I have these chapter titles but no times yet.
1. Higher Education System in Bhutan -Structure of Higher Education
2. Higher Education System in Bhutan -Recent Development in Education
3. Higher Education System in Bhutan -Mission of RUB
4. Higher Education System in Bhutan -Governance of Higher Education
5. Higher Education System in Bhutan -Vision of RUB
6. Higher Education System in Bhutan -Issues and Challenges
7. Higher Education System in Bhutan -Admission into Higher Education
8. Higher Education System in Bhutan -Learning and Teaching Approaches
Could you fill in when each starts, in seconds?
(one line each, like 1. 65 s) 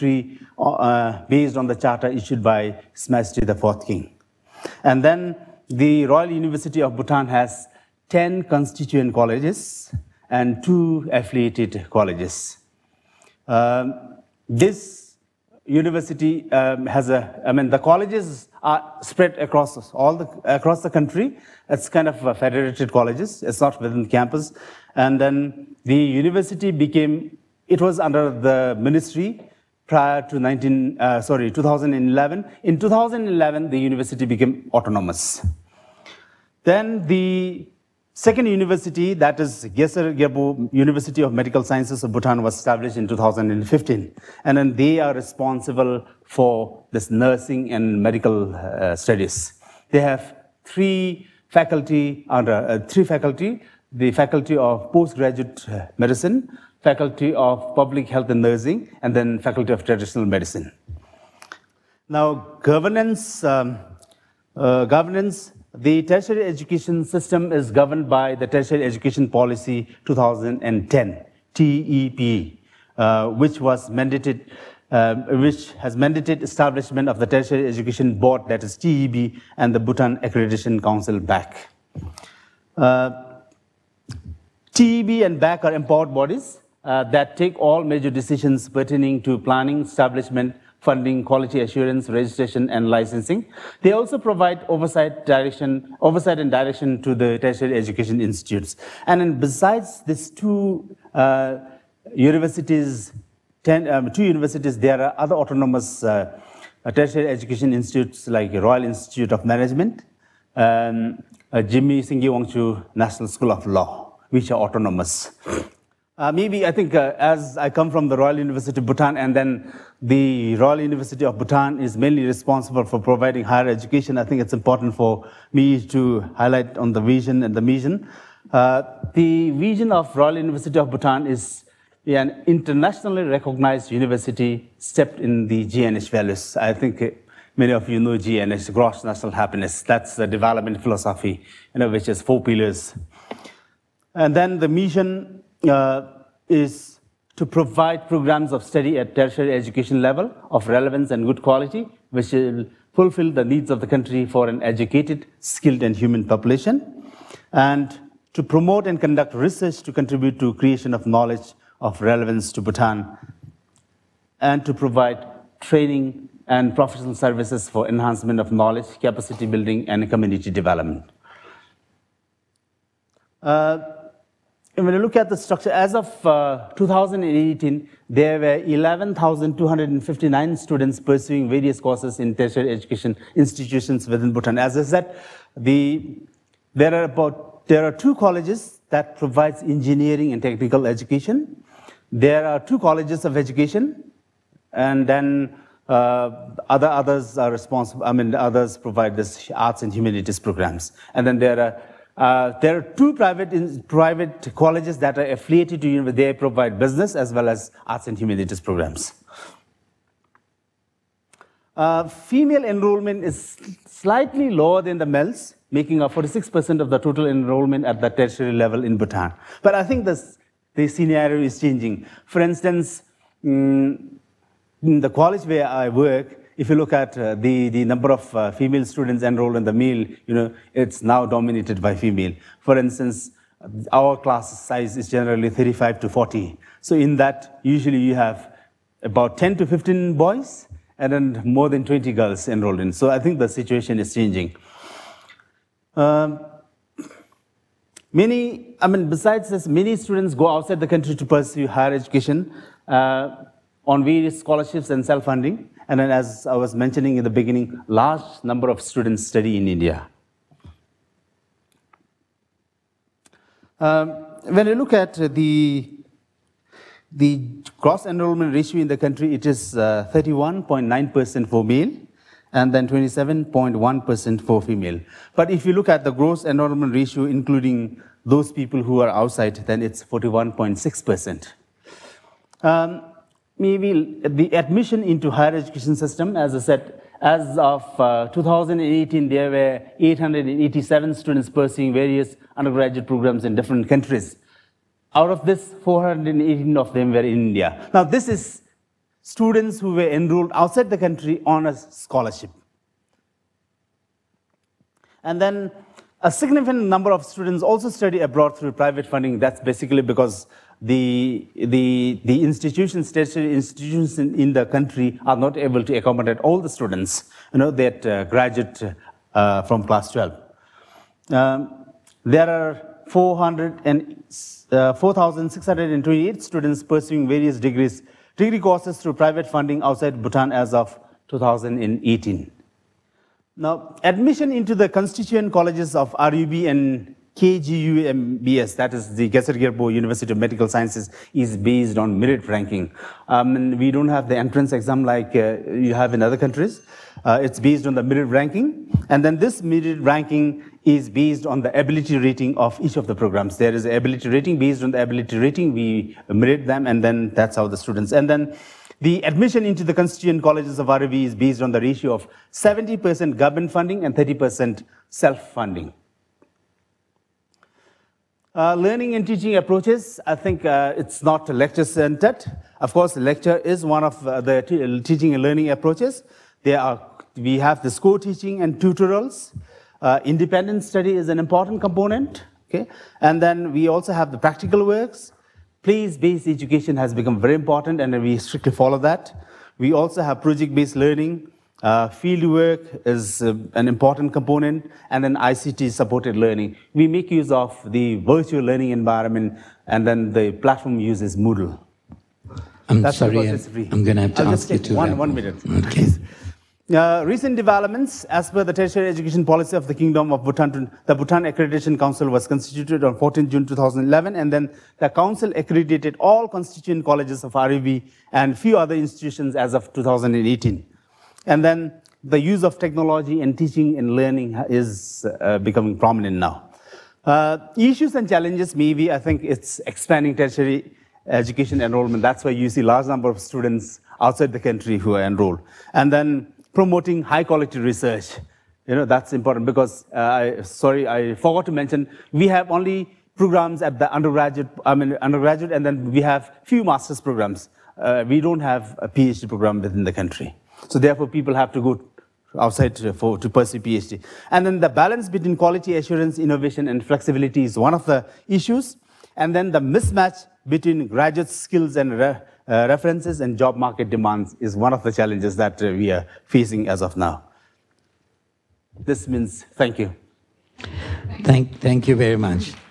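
1. 172 s
2. 406 s
3. 145 s
4. 62 s
5. 113 s
6. 427 s
7. 262 s
8. 367 s.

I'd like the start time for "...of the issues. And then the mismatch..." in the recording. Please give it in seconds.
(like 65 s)
457 s.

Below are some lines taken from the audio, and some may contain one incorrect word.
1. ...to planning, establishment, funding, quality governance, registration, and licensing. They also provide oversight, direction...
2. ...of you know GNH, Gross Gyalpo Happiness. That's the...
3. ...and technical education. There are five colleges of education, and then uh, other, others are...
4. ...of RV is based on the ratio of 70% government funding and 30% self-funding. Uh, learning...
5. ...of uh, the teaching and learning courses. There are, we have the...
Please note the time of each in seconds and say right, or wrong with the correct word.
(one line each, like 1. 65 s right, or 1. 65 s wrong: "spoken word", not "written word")
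1. 89 s wrong: "assurance", not "governance"
2. 137 s wrong: "National", not "Gyalpo"
3. 190 s wrong: "two", not "five"
4. 360 s right
5. 374 s wrong: "approaches", not "courses".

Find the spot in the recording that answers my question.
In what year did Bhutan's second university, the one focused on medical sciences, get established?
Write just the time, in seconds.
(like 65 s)
43 s.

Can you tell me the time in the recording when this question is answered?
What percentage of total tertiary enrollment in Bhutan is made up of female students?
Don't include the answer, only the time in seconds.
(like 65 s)
216 s.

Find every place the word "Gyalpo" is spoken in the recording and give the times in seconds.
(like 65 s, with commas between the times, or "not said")
40 s, 339 s.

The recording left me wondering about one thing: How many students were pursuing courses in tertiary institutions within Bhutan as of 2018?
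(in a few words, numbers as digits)
11,259.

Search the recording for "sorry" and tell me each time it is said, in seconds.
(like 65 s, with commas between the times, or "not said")
31 s, 403 s, 440 s.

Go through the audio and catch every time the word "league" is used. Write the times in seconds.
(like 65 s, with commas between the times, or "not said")
not said.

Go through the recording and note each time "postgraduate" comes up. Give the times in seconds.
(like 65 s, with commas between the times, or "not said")
54 s.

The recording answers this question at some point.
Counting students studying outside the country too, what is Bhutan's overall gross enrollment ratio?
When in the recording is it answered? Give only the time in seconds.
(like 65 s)
280 s.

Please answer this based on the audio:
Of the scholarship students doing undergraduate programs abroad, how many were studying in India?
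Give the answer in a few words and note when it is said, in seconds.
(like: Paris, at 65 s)
418, at 295 s.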